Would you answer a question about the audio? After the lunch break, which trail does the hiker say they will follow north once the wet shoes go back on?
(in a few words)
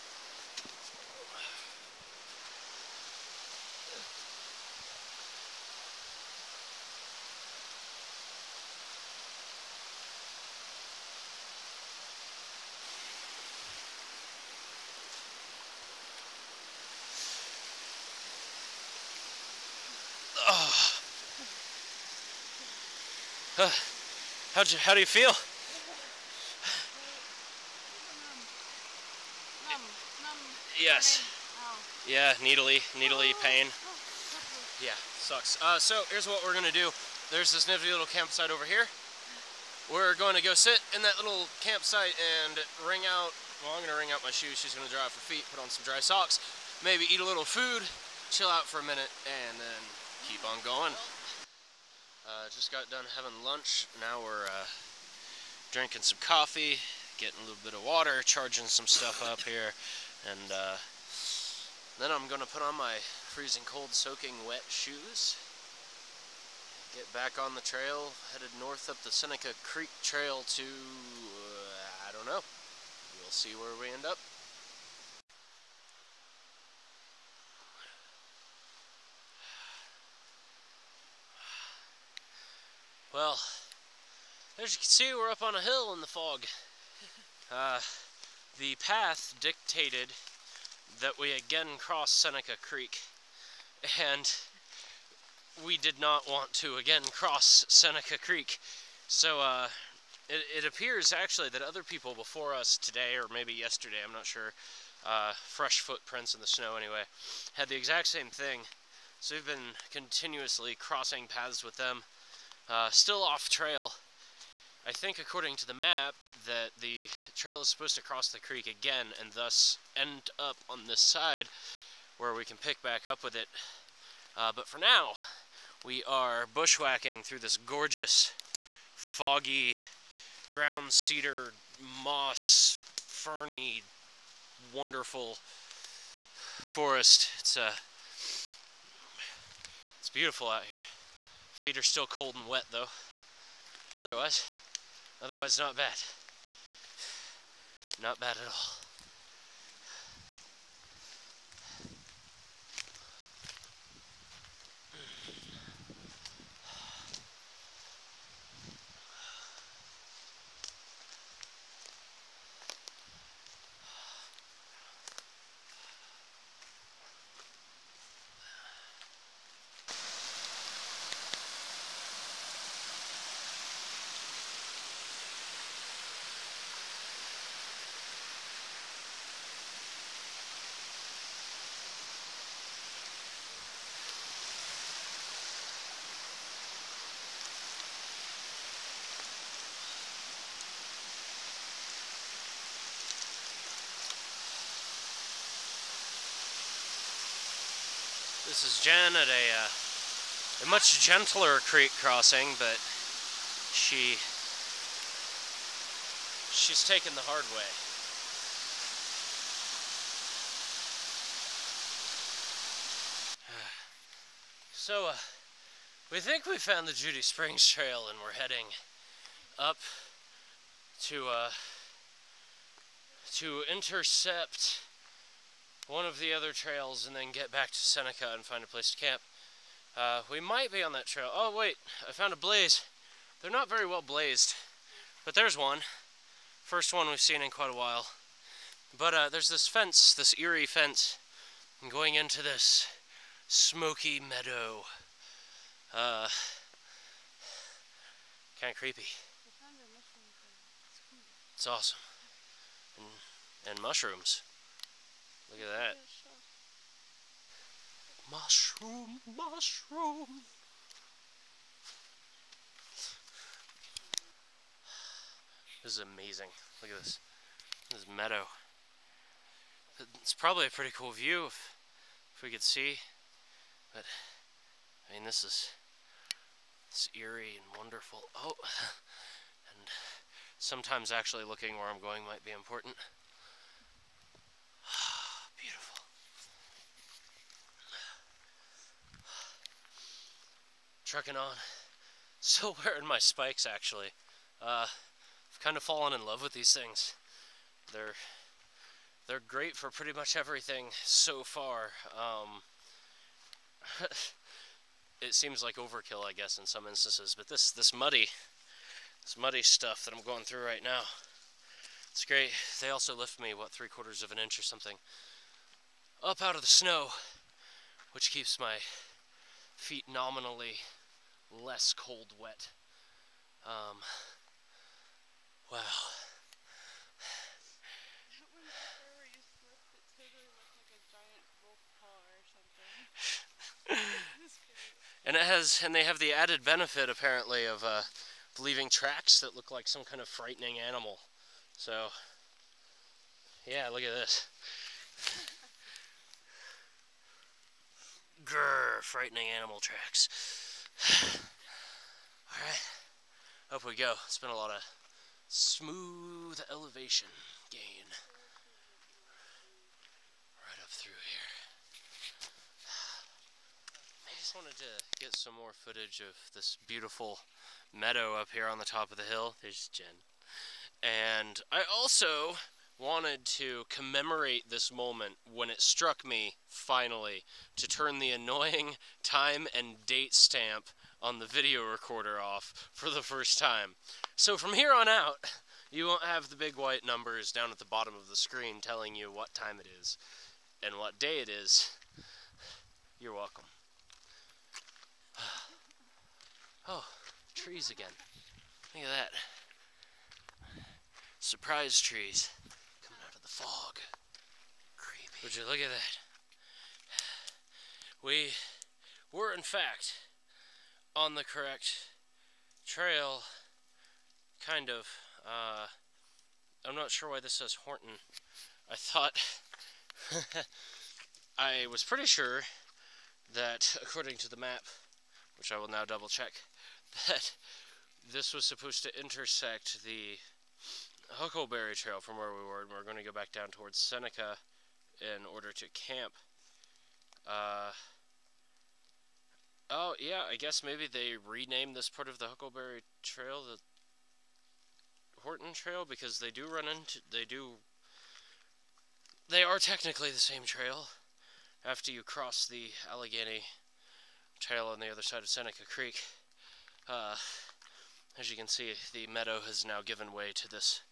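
Seneca Creek Trail.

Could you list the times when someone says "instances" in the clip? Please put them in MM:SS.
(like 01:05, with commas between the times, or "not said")
05:06.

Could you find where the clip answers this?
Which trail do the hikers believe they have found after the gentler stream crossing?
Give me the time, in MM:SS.
03:36.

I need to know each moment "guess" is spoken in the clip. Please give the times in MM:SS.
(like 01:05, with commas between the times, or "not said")
05:06, 07:20.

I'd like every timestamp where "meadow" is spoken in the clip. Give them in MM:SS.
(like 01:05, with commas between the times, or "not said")
04:04, 04:28, 06:07, 07:39.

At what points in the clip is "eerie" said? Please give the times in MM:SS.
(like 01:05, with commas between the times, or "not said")
04:00, 04:37.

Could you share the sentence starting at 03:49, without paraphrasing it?
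Uh, we might be on that trail.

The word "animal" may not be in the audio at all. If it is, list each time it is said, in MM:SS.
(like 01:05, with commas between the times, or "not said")
05:40, 05:49.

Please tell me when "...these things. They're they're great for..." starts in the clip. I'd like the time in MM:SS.
04:56.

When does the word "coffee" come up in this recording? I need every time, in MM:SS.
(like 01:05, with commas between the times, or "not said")
00:56.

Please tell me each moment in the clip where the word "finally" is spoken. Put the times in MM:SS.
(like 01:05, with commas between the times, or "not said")
06:16.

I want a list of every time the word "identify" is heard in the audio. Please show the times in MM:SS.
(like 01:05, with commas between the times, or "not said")
not said.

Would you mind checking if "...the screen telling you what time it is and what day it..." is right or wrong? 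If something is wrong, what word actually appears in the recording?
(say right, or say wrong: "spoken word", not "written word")
right.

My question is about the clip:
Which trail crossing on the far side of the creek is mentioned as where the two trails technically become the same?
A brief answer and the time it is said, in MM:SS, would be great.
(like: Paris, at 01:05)
Allegheny Trail, at 07:33.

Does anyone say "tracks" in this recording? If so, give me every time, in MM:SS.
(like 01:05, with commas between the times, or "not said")
05:38, 05:49.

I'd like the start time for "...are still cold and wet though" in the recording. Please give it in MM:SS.
02:21.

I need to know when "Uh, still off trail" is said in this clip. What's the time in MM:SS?
01:52.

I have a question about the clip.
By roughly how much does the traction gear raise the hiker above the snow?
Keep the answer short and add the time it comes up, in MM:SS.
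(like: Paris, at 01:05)
three quarters of an inch, at 05:13.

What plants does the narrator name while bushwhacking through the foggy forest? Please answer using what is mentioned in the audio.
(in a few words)
ground cedar.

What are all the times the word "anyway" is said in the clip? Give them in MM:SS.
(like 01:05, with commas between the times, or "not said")
01:46.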